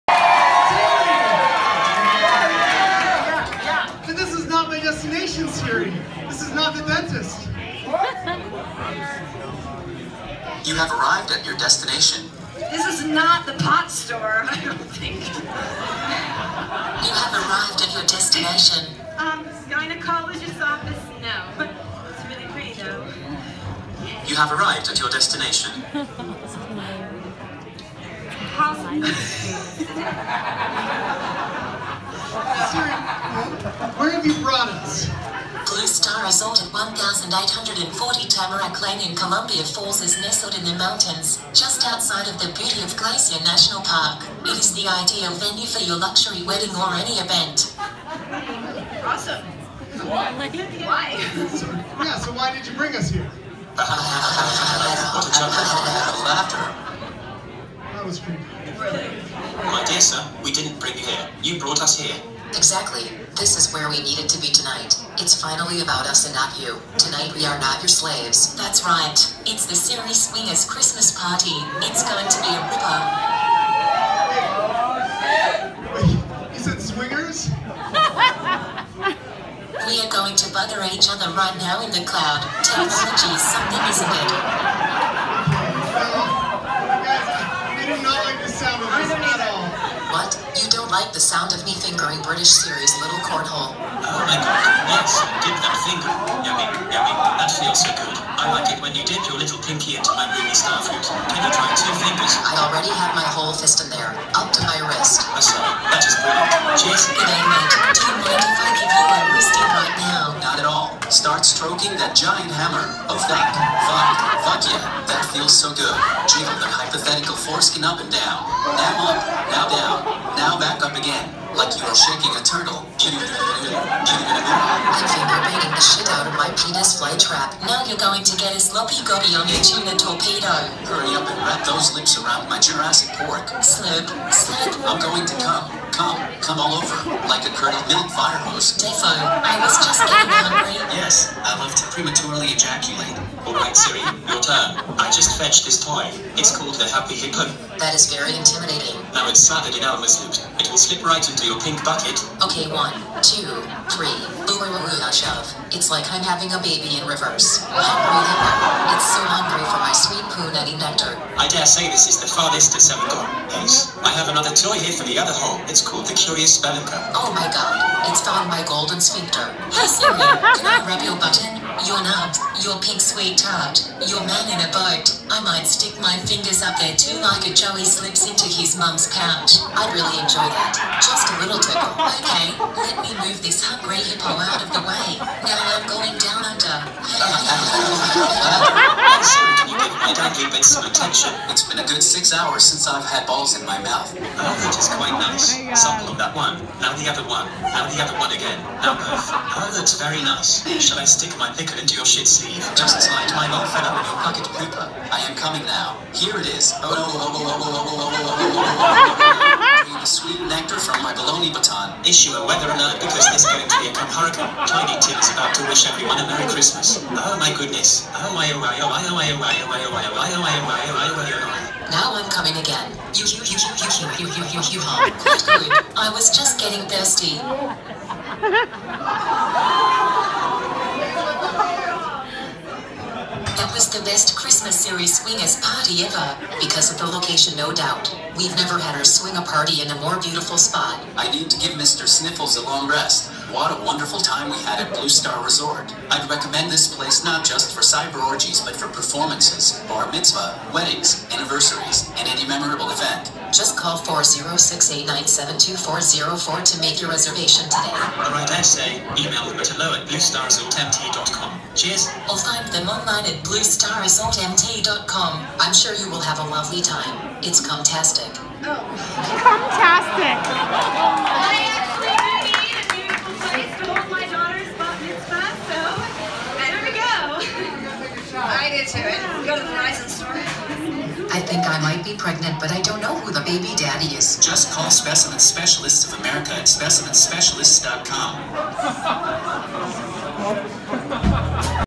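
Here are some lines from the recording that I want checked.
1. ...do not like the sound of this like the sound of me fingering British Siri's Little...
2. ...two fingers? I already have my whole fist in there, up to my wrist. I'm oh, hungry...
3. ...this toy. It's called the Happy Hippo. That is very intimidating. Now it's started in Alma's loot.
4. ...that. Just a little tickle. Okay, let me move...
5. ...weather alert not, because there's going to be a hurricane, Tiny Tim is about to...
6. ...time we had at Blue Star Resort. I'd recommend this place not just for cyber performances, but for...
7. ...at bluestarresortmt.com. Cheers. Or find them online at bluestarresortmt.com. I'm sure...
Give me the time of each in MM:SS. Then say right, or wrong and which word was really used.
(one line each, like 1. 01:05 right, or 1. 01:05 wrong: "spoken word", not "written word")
1. 01:27 right
2. 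01:41 wrong: "sorry", not "hungry"
3. 02:25 right
4. 03:00 right
5. 03:32 right
6. 04:04 wrong: "orgies", not "performances"
7. 04:19 right.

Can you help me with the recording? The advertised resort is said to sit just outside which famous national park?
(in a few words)
Glacier National Park.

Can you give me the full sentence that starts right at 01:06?
Tonight we are not your slaves.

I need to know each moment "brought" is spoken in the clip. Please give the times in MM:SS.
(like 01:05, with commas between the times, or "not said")
00:34, 01:01.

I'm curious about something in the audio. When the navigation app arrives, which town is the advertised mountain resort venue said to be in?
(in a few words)
Columbia Falls.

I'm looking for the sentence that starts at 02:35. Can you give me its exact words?
It's like I'm having a baby in reverse.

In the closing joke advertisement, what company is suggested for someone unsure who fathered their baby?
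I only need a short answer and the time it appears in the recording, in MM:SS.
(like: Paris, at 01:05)
Specimen Specialists of America, at 04:44.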